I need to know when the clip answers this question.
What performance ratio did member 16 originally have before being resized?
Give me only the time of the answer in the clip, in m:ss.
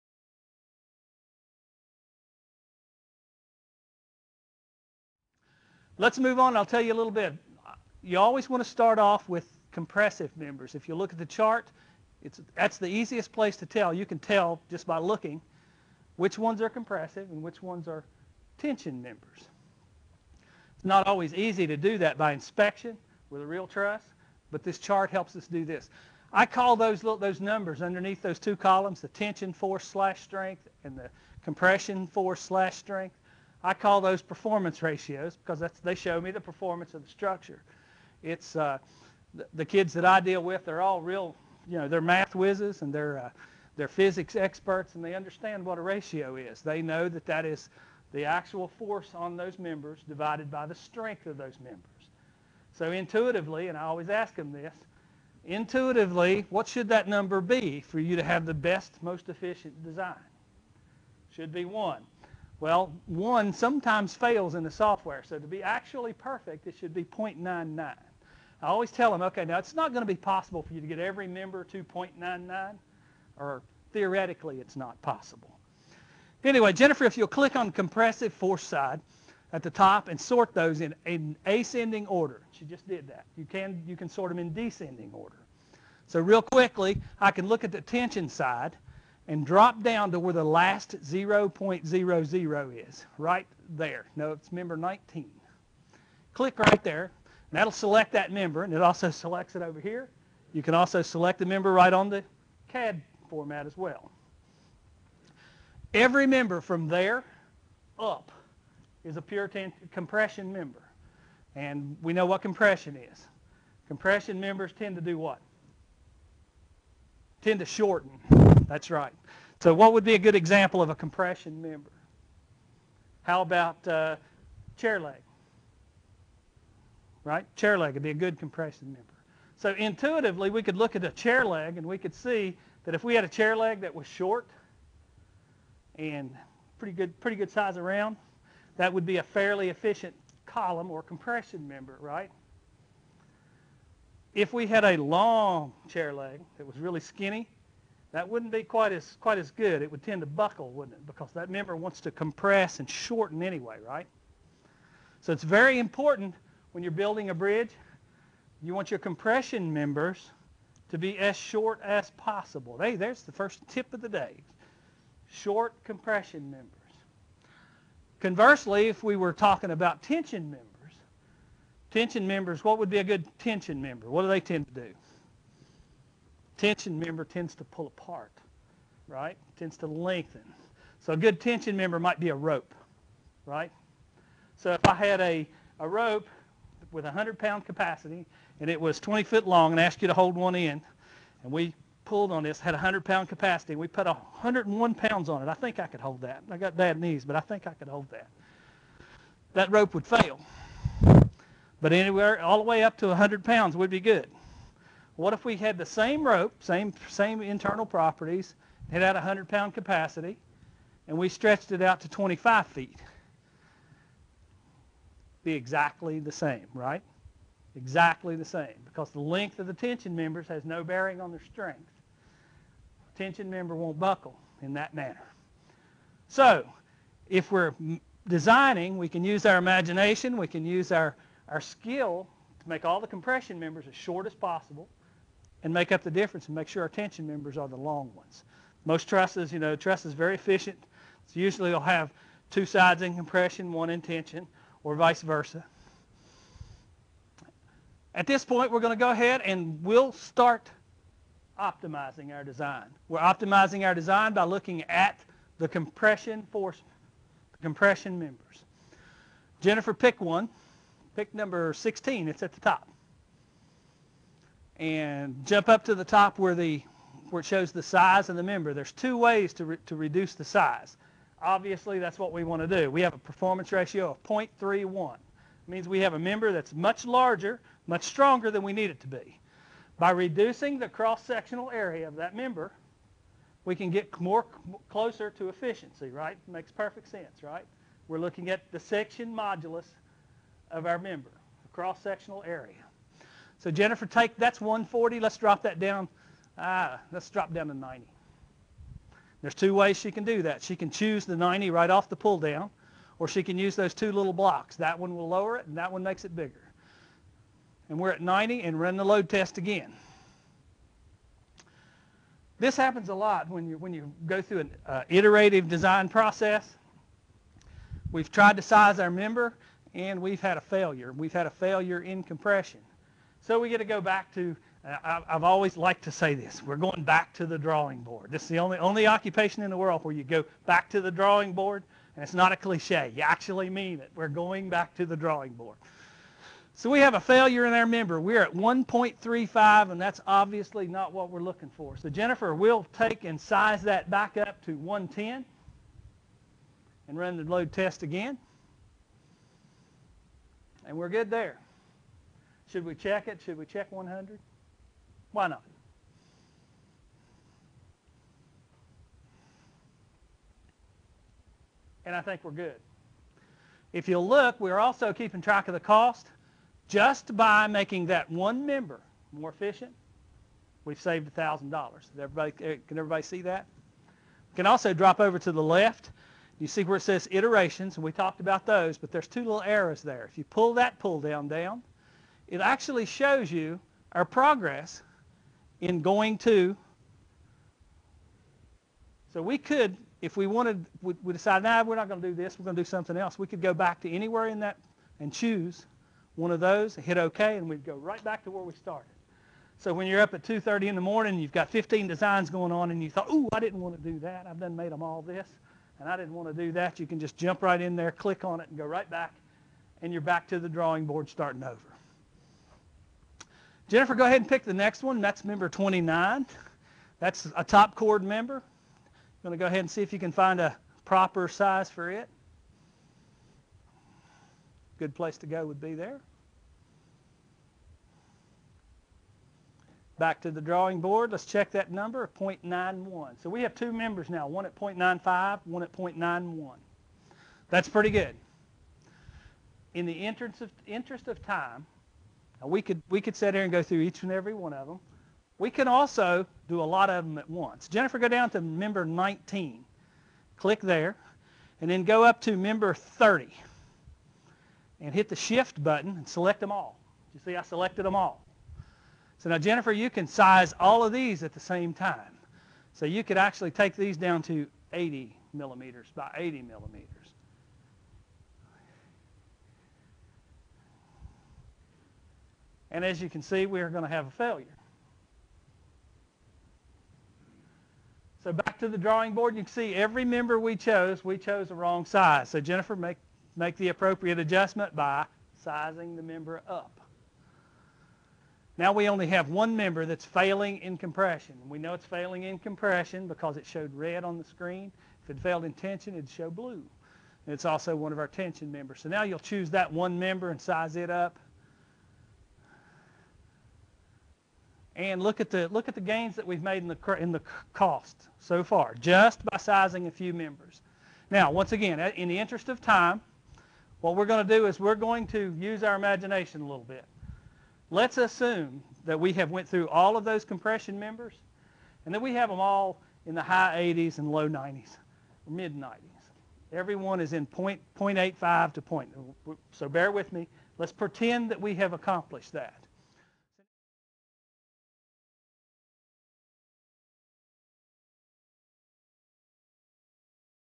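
4:34.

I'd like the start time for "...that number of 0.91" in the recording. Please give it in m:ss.
7:11.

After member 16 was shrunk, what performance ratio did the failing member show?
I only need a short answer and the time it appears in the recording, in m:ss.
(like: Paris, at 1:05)
1.35, at 5:38.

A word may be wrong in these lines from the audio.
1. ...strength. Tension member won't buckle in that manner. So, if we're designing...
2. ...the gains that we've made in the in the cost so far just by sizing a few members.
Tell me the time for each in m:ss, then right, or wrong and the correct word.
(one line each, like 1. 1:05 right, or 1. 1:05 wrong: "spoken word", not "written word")
1. 3:41 right
2. 8:25 right.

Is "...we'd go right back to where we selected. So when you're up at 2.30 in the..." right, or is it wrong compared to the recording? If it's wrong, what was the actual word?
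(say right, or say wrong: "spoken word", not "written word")
wrong: "started", not "selected".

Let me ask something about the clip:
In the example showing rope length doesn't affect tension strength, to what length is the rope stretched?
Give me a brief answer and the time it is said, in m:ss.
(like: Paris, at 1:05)
25 feet, at 3:32.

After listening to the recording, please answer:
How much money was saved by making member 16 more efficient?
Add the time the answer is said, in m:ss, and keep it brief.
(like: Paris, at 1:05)
$1,000, at 6:11.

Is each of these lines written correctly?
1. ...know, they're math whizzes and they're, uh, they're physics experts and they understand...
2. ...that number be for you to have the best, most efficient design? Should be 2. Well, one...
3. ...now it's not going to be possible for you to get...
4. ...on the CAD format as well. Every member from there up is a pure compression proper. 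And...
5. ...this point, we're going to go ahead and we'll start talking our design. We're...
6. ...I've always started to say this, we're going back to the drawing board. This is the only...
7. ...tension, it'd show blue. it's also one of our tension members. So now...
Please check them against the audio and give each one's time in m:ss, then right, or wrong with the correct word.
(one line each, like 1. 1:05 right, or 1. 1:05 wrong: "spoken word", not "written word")
1. 0:41 right
2. 0:56 wrong: "1", not "2"
3. 1:09 right
4. 1:41 wrong: "member", not "proper"
5. 4:08 wrong: "optimizing", not "talking"
6. 5:25 wrong: "liked", not "started"
7. 8:15 right.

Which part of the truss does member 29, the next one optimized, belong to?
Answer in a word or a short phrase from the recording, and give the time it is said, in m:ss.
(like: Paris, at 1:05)
Top chord, at 6:57.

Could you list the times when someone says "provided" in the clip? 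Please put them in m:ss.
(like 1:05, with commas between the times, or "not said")
not said.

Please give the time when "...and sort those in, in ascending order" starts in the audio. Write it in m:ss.
1:20.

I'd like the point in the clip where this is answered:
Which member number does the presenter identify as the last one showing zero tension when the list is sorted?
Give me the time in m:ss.
1:34.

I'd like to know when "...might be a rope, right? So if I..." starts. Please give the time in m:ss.
3:01.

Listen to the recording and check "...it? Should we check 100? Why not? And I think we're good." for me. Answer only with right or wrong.
right.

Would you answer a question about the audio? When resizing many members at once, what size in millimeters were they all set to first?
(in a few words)
80 by 80.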